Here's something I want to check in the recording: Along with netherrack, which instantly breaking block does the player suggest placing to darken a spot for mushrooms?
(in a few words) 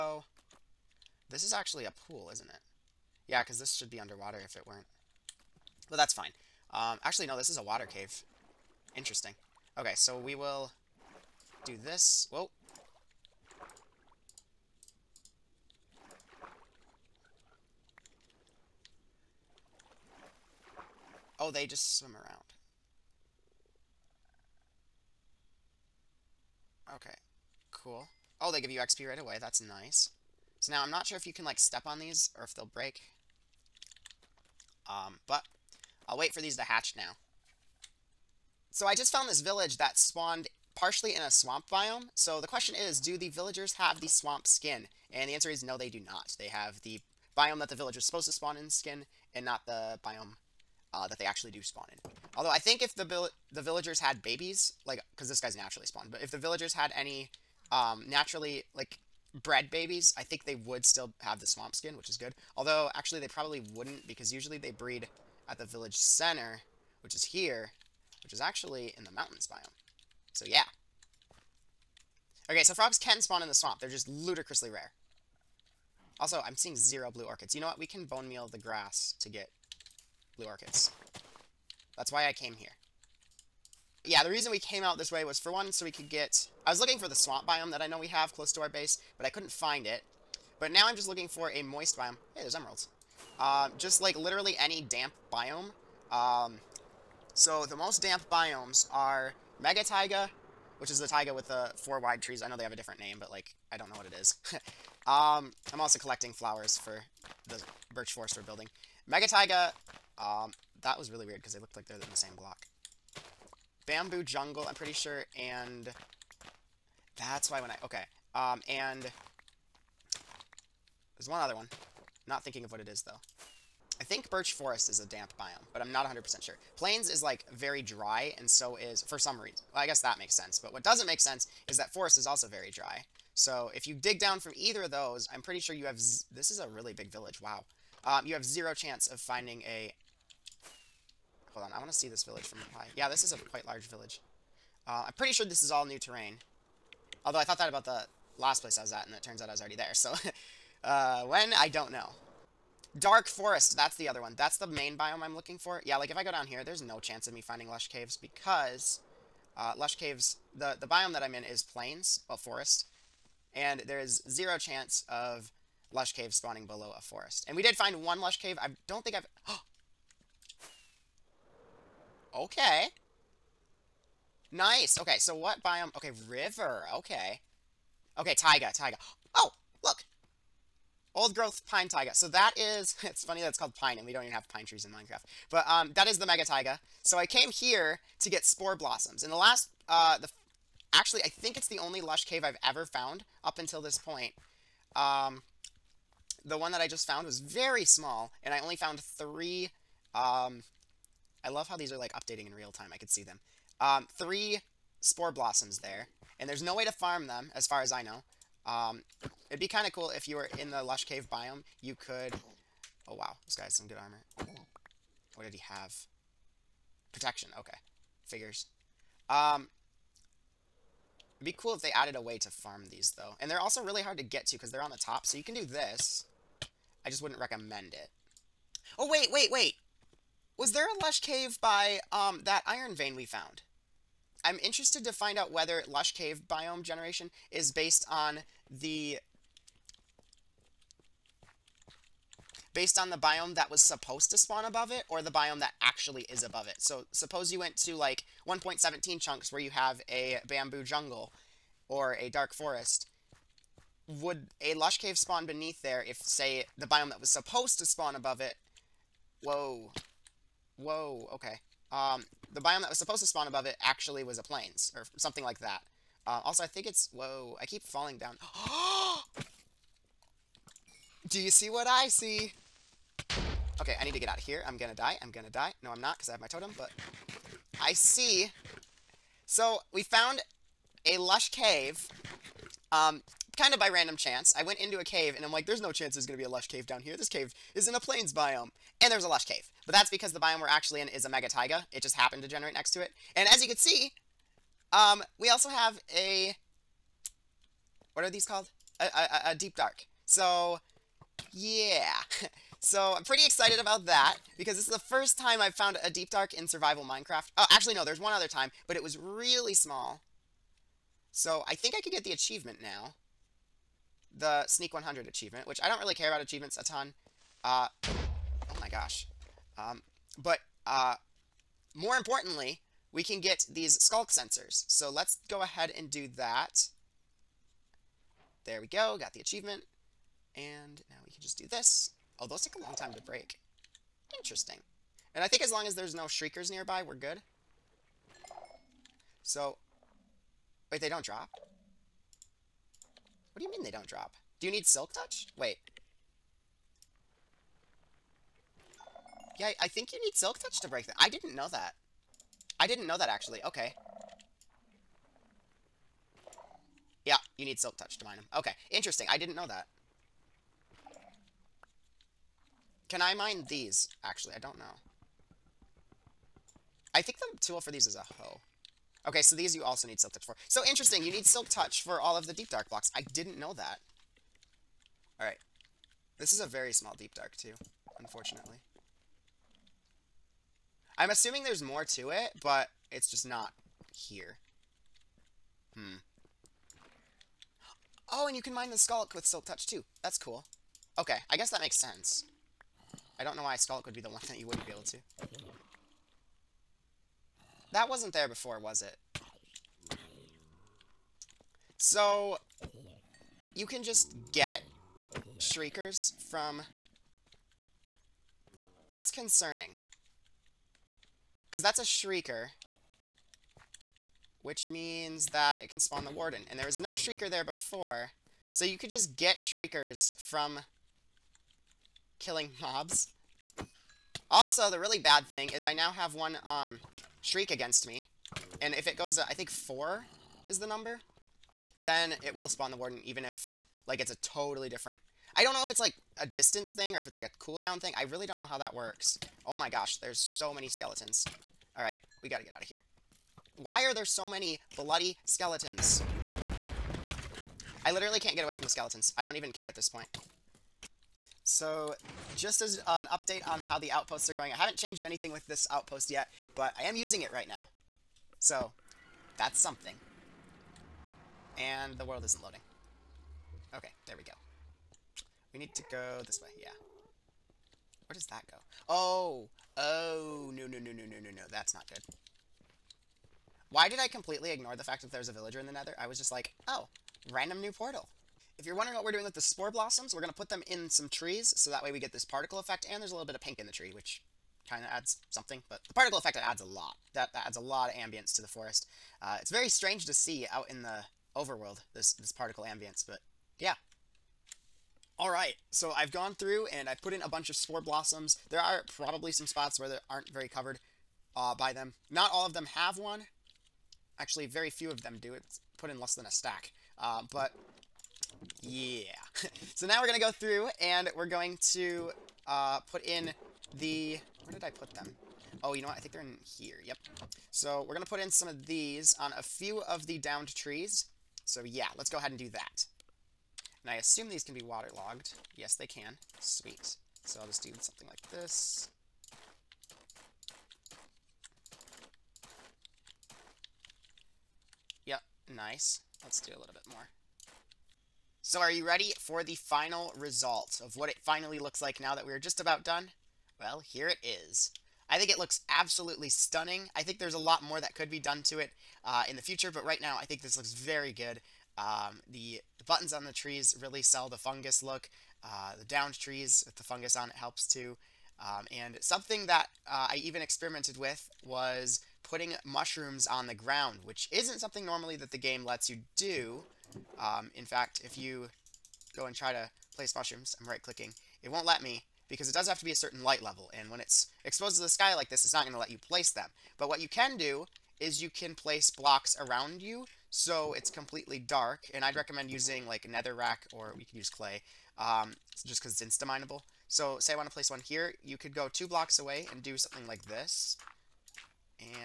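Clay.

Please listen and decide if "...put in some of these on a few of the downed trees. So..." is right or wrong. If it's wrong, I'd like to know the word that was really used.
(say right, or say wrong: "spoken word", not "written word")
right.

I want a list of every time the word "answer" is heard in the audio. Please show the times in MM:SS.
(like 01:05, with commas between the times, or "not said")
00:45.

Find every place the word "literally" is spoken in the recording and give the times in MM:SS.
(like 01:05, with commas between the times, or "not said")
01:34, 07:28.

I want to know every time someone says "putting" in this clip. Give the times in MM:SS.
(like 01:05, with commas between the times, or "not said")
09:22.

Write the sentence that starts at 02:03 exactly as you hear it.
I think birch forest is a damp biome, but I'm not 100% sure.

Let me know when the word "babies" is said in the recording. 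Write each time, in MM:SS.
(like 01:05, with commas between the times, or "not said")
00:54, 00:59.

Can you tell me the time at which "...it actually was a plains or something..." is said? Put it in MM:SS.
04:23.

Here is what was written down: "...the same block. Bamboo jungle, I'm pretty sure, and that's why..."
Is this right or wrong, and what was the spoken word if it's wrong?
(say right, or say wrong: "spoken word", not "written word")
right.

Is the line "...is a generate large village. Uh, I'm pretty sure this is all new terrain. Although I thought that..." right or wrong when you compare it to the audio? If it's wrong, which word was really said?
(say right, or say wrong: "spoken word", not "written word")
wrong: "quite", not "generate".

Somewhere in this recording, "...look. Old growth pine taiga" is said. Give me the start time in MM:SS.
02:59.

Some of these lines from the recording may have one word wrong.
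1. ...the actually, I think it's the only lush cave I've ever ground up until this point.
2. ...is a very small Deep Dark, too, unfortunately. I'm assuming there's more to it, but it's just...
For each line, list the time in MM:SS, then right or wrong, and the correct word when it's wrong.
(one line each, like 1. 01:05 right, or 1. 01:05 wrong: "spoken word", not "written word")
1. 03:10 wrong: "found", not "ground"
2. 06:16 right.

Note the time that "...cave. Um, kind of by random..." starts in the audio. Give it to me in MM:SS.
04:41.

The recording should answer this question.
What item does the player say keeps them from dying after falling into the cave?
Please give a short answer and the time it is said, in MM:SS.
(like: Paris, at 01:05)
Totem, at 04:36.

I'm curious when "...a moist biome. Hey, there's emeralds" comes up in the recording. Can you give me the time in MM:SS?
01:31.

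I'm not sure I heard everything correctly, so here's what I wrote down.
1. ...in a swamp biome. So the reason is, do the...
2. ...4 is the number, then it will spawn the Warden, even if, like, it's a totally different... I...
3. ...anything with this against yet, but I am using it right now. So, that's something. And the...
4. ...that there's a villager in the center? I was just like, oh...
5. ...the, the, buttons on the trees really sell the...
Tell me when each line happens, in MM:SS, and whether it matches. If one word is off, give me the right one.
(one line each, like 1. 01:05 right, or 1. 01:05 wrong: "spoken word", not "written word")
1. 00:41 wrong: "question", not "reason"
2. 07:09 right
3. 07:35 wrong: "outpost", not "against"
4. 07:55 wrong: "nether", not "center"
5. 09:12 right.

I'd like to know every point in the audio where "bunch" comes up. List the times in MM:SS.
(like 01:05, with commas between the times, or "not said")
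08:17.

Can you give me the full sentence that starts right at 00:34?
Um, but I'll wait for these to hatch now.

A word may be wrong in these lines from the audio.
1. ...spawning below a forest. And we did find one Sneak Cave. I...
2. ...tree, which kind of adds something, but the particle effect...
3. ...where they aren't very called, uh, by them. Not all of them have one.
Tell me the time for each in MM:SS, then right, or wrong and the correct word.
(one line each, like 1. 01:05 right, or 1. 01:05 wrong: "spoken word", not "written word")
1. 02:46 wrong: "Lush", not "Sneak"
2. 08:03 right
3. 08:19 wrong: "covered", not "called".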